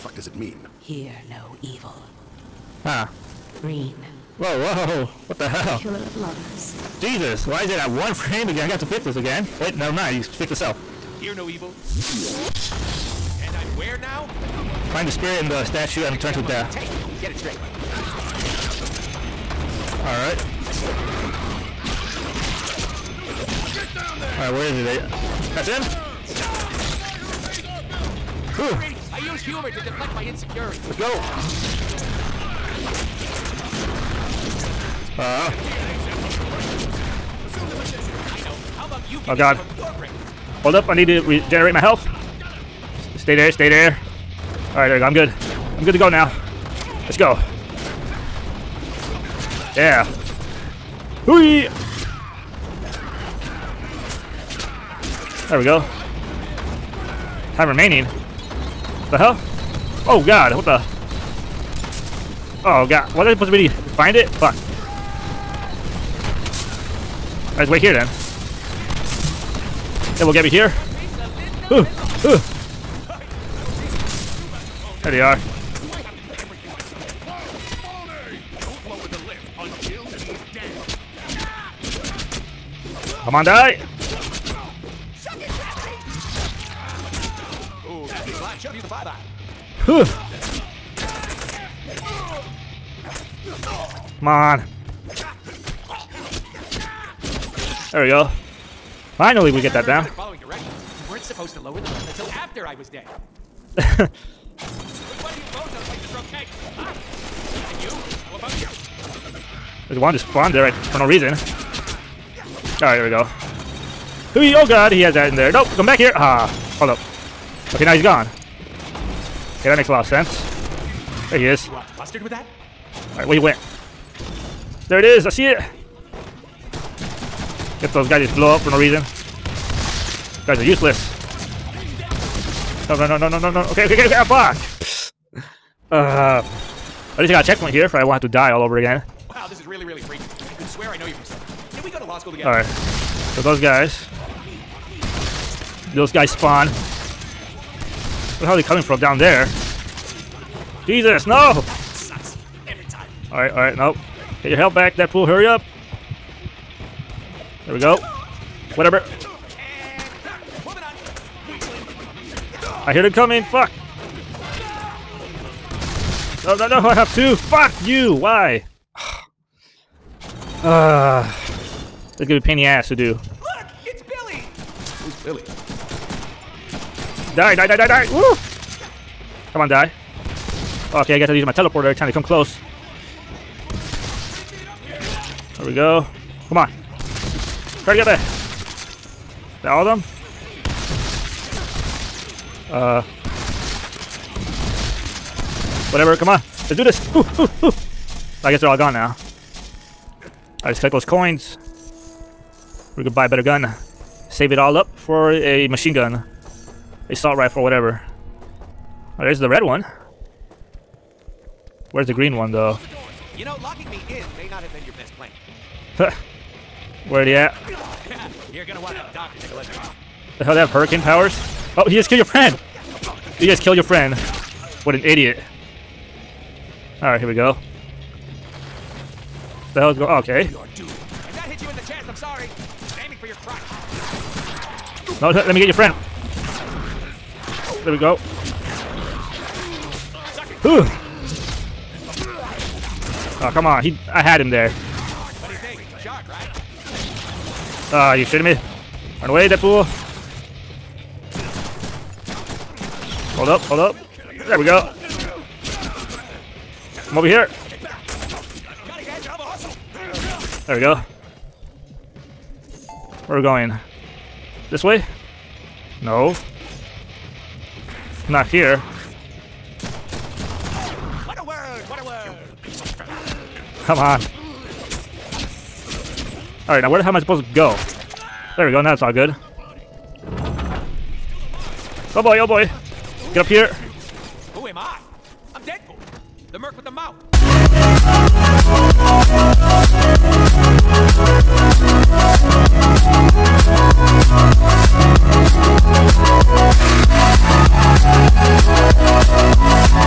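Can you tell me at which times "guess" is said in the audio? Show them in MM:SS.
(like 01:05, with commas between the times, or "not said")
03:01, 03:18.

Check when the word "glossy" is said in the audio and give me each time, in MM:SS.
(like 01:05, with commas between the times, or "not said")
not said.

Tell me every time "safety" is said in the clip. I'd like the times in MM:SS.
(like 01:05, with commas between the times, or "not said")
not said.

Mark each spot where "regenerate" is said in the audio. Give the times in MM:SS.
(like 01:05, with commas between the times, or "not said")
00:41.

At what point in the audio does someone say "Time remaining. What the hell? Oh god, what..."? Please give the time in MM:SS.
00:57.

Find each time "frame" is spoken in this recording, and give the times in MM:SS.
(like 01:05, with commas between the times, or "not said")
00:08.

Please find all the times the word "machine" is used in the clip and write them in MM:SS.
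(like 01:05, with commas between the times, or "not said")
03:25.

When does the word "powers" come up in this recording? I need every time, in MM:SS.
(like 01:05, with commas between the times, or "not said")
03:41.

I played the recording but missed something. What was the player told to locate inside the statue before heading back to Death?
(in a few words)
The spirit.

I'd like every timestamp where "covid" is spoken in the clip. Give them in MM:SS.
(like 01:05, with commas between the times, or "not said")
not said.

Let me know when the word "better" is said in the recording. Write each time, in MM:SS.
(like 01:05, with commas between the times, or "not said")
03:23.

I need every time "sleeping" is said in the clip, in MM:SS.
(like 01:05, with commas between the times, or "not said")
not said.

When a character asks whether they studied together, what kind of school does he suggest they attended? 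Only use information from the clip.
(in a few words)
Law school.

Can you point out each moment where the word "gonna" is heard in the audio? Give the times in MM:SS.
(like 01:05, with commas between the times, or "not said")
02:52, 03:38.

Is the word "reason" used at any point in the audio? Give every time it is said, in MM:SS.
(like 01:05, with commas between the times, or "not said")
01:51, 02:08.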